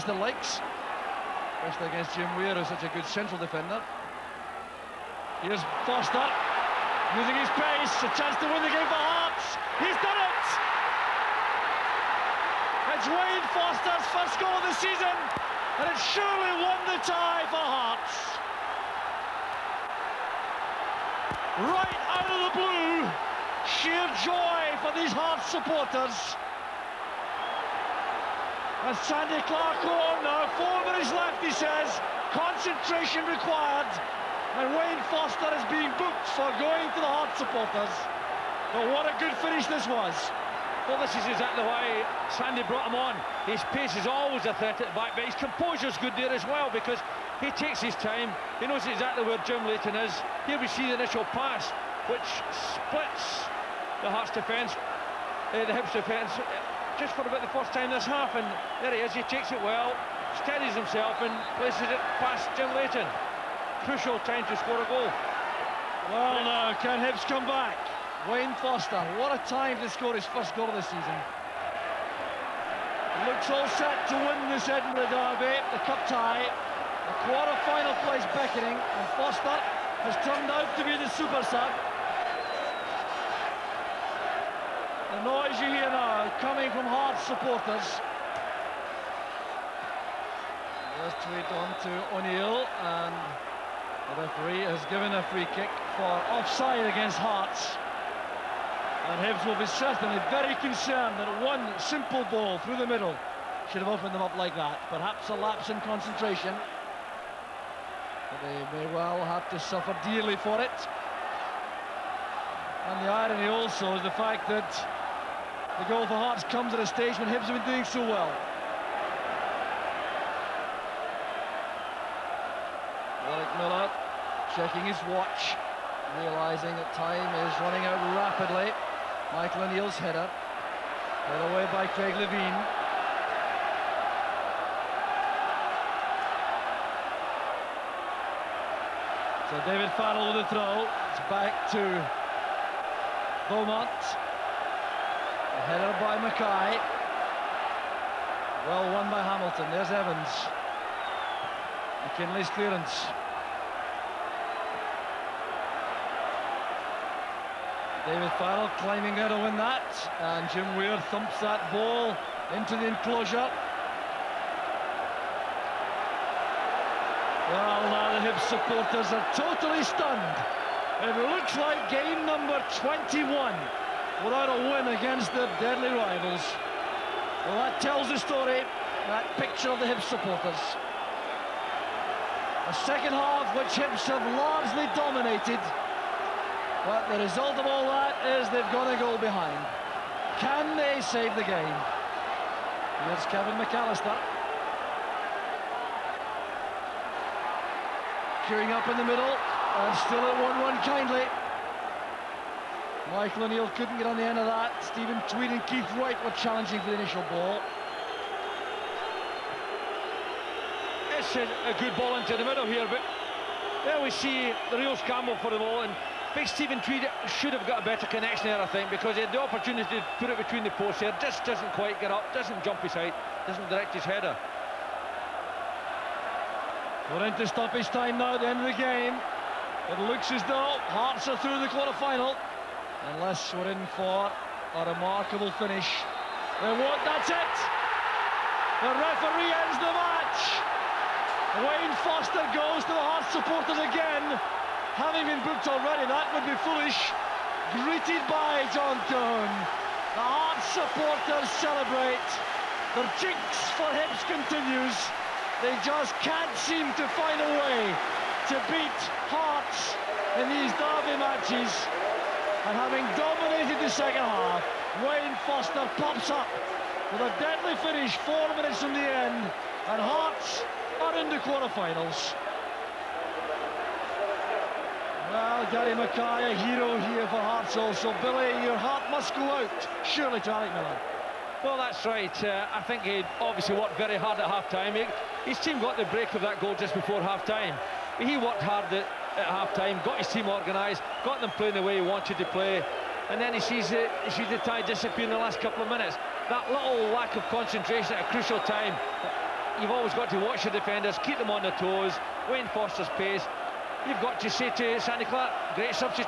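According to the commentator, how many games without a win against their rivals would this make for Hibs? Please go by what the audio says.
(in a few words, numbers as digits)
21.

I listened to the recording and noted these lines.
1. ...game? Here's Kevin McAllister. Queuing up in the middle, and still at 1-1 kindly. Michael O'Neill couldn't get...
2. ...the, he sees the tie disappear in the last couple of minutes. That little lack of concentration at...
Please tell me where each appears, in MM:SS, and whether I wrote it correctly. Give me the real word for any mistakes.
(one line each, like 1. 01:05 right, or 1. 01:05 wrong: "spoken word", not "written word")
1. 03:11 right
2. 04:53 right.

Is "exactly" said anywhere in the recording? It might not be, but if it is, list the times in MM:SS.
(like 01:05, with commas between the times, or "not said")
00:41, 00:48.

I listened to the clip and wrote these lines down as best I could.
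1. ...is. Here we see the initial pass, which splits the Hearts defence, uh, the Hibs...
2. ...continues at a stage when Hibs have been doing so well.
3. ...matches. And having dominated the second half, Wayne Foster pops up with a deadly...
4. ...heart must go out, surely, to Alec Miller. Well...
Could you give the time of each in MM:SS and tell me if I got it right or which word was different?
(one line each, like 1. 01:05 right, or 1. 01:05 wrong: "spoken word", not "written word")
1. 00:49 right
2. 01:56 wrong: "comes", not "continues"
3. 04:21 right
4. 04:38 right.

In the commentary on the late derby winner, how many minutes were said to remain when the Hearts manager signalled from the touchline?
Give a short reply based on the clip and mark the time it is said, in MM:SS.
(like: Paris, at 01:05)
4, at 00:30.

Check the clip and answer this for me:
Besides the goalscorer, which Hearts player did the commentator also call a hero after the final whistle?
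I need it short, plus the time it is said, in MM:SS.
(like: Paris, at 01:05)
Gary Mackay, at 04:35.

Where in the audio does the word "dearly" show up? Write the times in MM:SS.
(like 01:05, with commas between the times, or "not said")
01:50.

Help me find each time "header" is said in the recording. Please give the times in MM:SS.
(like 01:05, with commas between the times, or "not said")
02:09, 02:25, 03:44.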